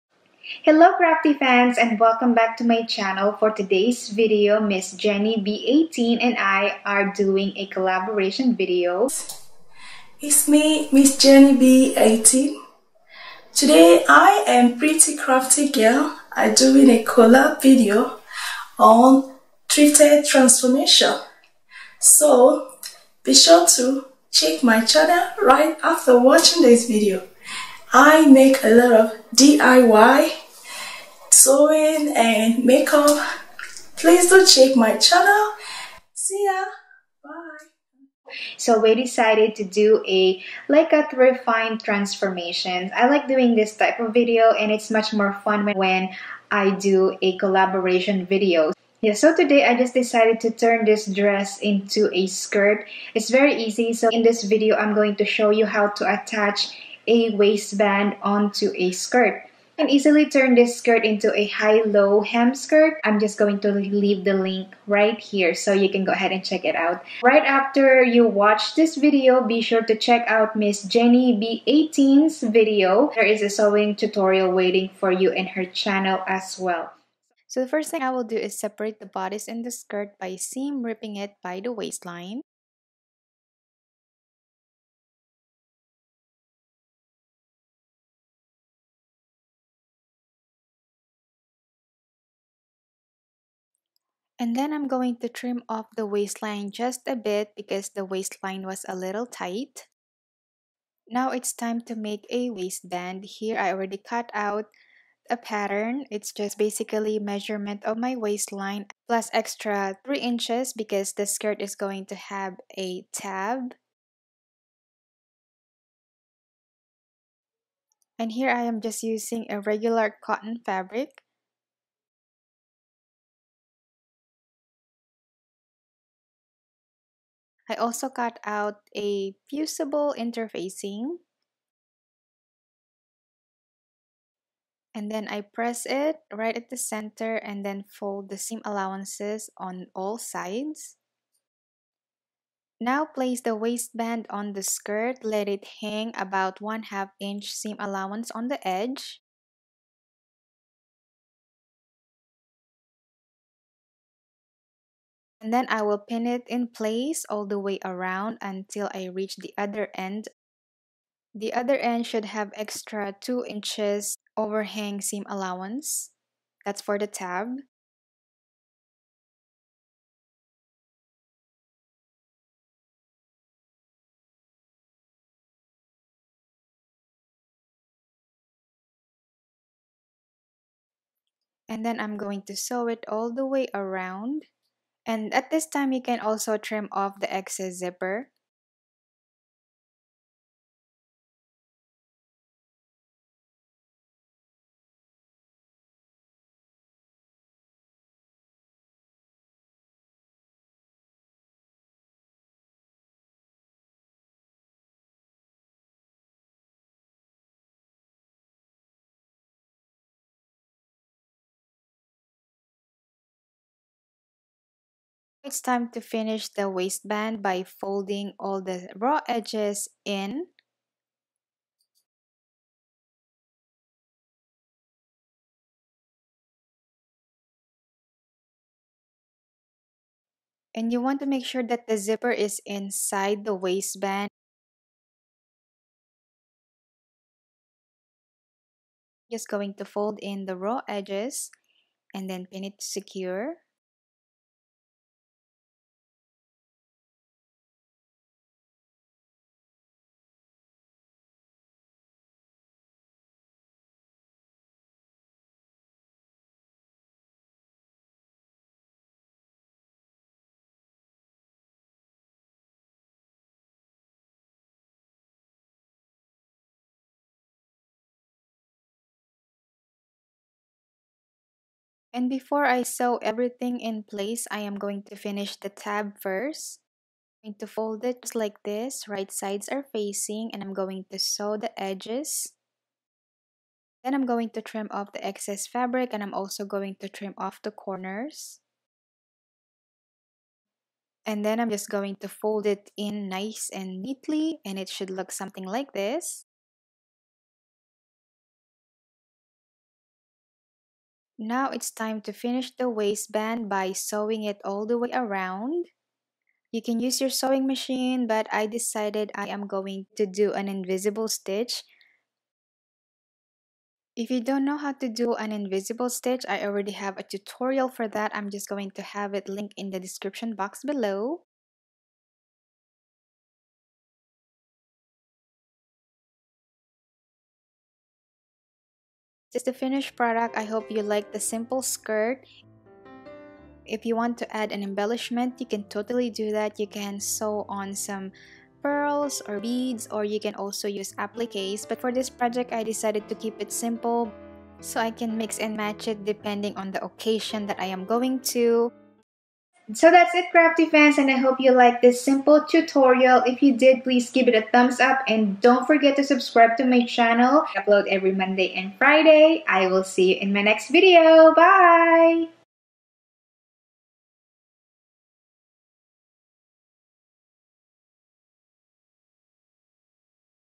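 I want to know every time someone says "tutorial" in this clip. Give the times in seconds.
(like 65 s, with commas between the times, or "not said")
73 s, 317 s, 352 s.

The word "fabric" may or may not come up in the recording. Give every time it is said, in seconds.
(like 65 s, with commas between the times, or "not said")
120 s, 285 s.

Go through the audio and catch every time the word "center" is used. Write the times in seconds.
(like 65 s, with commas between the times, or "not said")
136 s.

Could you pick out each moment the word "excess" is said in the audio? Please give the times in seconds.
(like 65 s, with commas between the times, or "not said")
187 s, 285 s.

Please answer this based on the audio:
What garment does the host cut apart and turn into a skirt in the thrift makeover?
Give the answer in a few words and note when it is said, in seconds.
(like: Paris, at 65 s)
dress, at 50 s.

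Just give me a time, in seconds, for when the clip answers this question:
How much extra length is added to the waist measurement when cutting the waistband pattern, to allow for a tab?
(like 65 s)
109 s.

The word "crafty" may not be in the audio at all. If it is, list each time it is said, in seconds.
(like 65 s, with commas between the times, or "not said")
0 s, 15 s, 350 s.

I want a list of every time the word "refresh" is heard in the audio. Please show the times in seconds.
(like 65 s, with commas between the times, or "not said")
not said.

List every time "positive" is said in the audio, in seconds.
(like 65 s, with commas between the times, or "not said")
not said.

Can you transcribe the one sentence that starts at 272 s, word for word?
And before I sew everything in place, I am going to finish the tab first.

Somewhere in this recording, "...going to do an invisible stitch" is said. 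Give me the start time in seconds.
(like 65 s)
309 s.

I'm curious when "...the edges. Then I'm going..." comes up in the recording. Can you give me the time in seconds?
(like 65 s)
281 s.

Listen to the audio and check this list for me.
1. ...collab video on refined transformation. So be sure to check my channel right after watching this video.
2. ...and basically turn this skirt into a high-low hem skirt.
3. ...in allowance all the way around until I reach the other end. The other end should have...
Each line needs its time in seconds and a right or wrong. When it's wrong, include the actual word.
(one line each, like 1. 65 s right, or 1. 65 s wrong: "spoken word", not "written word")
1. 17 s wrong: "thrifted", not "refined"
2. 59 s wrong: "easily", not "basically"
3. 156 s wrong: "place", not "allowance".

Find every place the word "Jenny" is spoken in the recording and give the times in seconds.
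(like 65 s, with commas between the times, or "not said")
4 s, 11 s, 70 s.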